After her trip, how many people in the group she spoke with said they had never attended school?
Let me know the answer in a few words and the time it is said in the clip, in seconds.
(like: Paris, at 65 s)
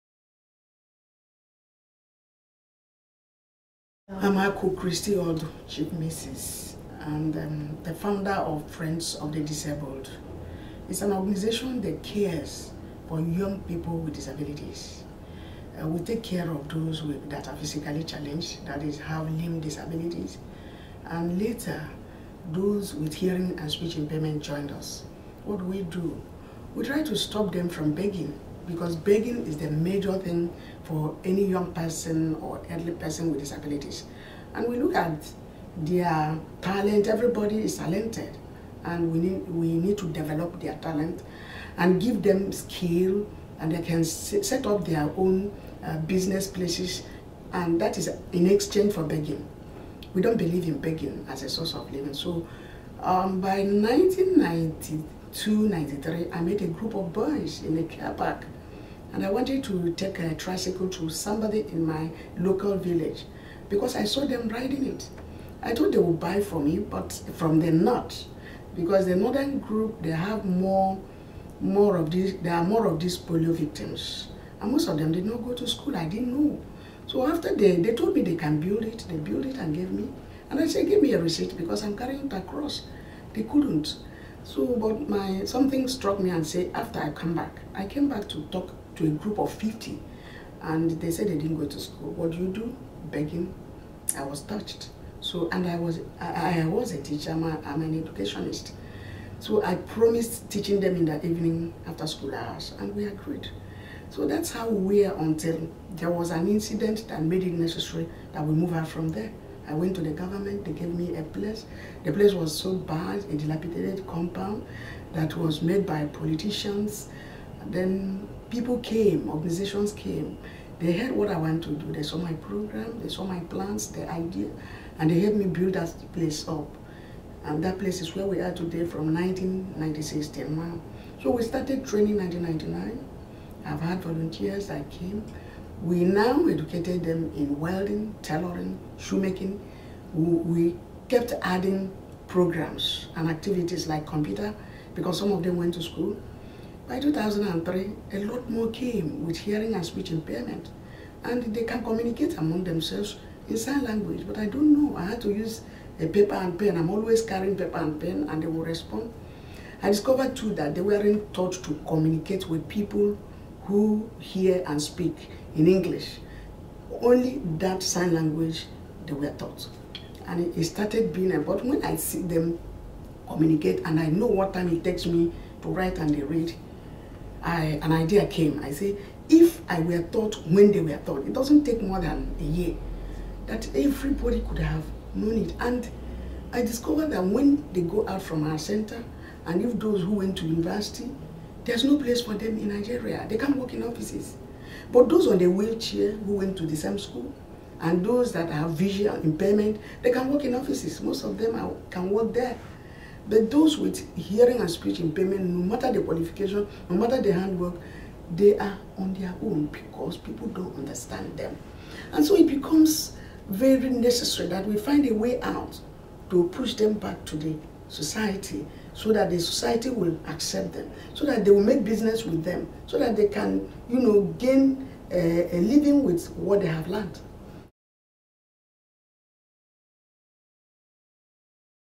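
50, at 89 s.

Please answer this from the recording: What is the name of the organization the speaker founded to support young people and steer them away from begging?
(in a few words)
Friends of the Disabled.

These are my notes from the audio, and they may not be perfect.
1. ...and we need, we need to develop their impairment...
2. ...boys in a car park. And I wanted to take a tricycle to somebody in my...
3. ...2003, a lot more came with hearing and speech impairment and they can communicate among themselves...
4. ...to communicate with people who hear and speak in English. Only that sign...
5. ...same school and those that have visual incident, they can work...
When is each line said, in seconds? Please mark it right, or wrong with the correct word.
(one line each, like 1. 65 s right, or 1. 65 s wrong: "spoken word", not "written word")
1. 38 s wrong: "talent", not "impairment"
2. 57 s right
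3. 146 s right
4. 161 s right
5. 196 s wrong: "impairment", not "incident".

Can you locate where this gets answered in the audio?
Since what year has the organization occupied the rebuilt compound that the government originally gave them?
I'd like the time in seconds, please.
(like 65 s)
129 s.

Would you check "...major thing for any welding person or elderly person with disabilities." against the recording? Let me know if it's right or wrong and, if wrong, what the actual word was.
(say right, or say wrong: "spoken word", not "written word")
wrong: "young", not "welding".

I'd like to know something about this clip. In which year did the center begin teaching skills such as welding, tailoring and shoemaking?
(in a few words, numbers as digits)
1999.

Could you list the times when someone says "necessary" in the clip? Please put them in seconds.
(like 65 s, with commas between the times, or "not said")
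107 s, 213 s.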